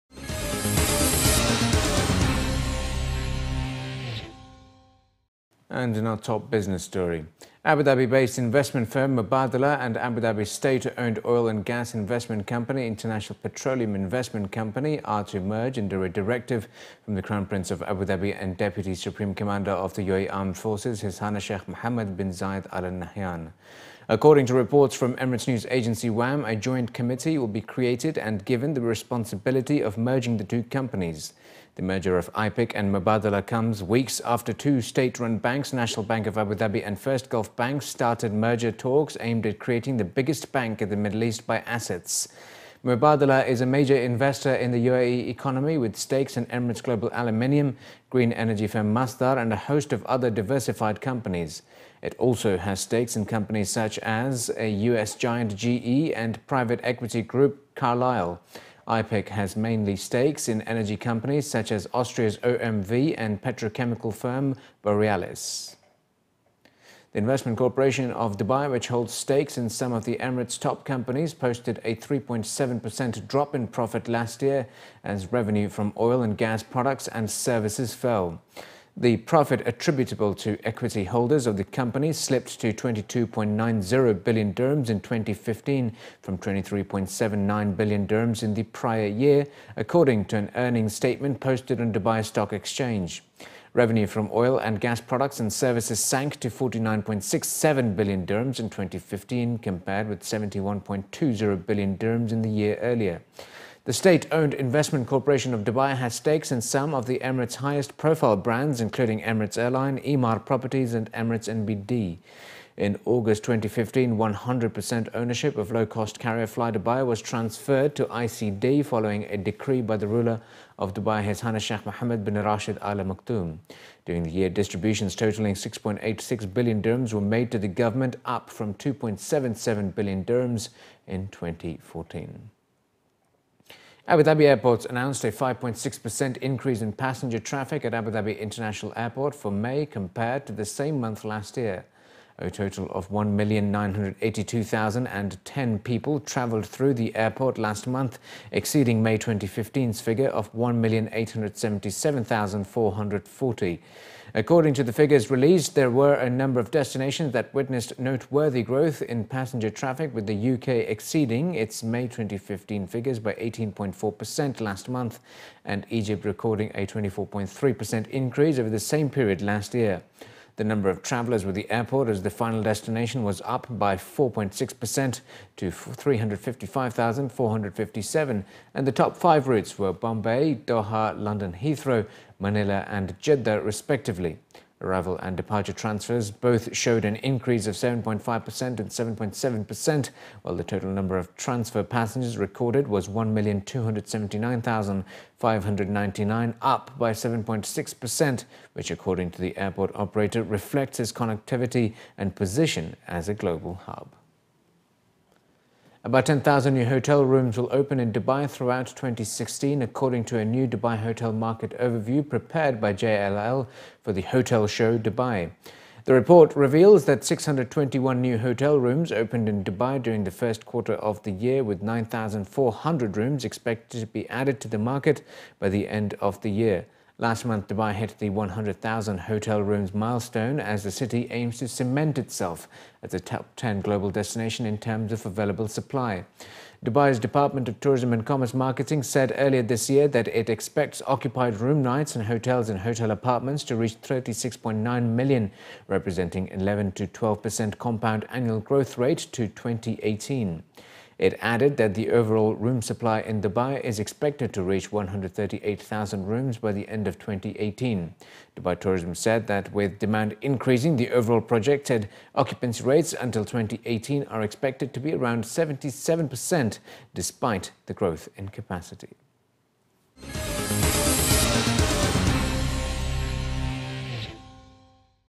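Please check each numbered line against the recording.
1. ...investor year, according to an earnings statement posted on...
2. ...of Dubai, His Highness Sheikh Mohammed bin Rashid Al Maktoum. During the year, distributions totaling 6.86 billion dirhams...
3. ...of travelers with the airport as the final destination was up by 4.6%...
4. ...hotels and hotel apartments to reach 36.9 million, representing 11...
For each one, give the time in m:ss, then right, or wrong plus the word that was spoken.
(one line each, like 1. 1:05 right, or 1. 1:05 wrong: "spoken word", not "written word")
1. 1:28 wrong: "prior", not "investor"
2. 2:00 right
3. 2:50 right
4. 4:02 right.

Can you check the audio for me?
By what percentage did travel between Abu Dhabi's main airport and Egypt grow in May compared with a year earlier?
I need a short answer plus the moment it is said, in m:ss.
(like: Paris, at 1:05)
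24.3%, at 2:46.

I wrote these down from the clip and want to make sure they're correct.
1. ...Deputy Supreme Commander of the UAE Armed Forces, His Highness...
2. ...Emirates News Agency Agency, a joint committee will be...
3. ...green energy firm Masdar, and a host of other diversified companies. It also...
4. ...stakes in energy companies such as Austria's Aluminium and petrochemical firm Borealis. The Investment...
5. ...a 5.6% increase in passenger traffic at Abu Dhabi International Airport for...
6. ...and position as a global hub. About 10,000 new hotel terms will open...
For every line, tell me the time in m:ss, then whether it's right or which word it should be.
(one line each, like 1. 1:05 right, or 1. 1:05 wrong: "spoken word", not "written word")
1. 0:18 right
2. 0:25 wrong: "WAM", not "Agency"
3. 0:48 right
4. 0:59 wrong: "OMV", not "Aluminium"
5. 2:15 right
6. 3:22 wrong: "rooms", not "terms".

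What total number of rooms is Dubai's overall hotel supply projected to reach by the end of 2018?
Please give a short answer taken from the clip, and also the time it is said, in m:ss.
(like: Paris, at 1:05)
138,000, at 4:14.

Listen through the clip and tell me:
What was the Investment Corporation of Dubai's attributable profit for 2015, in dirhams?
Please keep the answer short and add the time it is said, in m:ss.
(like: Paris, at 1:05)
22.90 billion dirhams, at 1:22.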